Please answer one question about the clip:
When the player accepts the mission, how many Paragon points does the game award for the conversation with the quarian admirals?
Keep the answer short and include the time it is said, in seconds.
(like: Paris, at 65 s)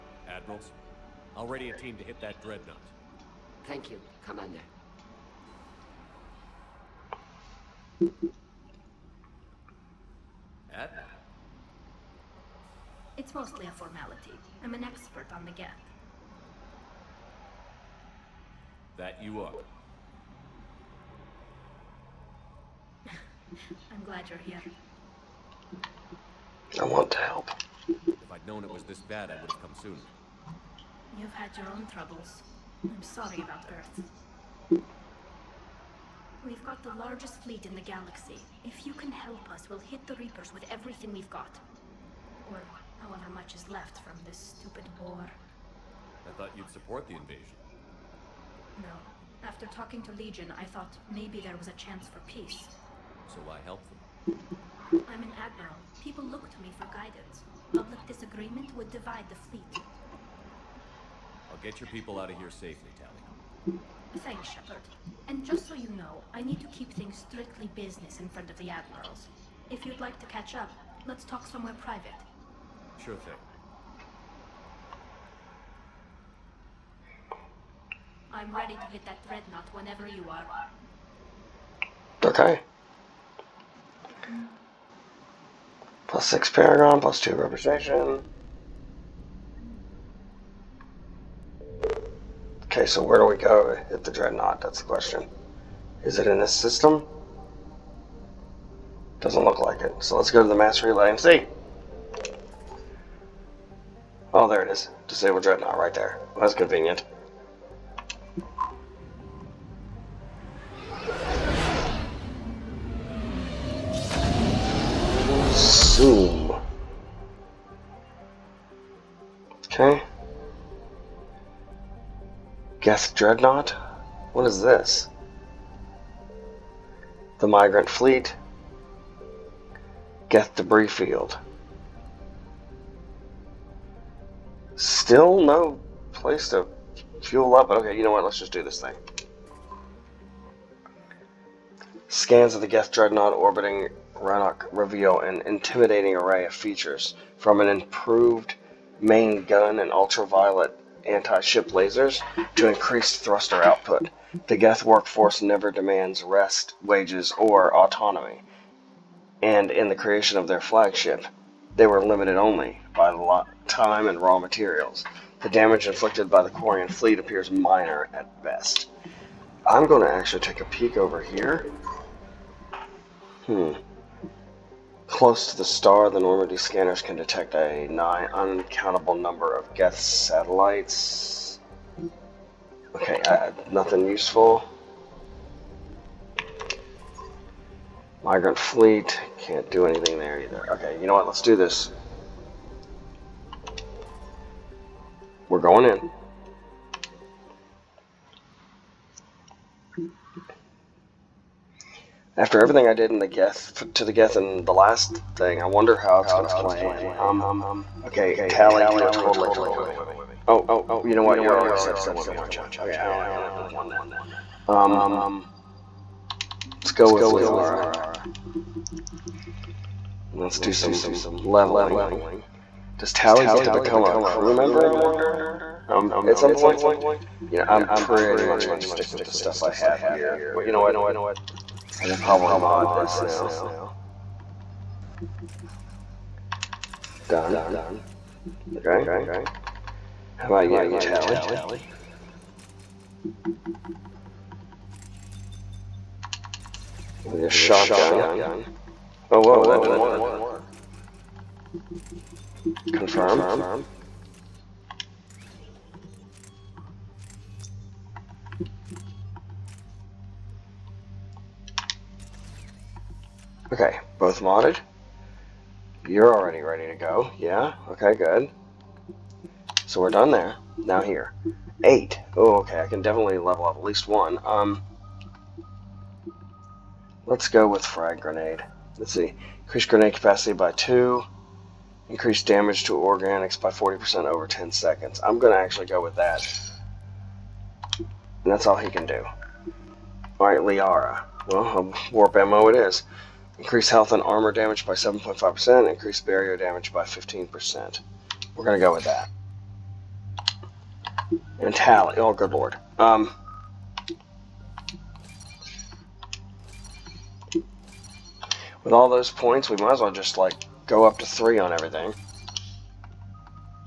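6, at 86 s.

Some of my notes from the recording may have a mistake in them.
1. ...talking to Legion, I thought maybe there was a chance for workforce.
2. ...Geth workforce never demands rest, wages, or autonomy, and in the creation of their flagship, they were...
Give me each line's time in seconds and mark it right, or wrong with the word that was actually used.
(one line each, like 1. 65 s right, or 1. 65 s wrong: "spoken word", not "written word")
1. 49 s wrong: "peace", not "workforce"
2. 154 s right.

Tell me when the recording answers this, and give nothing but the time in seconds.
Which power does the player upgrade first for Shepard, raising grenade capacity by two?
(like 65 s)
277 s.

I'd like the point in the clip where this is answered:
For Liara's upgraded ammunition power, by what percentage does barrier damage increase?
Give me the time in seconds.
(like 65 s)
297 s.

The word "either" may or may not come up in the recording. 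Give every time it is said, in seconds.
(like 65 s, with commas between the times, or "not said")
190 s.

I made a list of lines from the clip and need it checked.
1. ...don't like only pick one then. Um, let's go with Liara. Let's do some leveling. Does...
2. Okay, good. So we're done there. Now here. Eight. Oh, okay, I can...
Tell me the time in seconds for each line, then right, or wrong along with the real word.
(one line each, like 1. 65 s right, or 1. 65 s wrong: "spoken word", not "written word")
1. 213 s right
2. 267 s right.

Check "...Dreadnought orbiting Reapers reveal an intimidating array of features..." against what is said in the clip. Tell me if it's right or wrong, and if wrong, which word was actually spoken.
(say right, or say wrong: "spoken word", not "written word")
wrong: "Rannoch", not "Reapers".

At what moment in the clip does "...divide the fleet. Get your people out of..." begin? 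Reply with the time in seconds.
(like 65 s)
58 s.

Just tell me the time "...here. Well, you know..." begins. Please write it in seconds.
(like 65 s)
230 s.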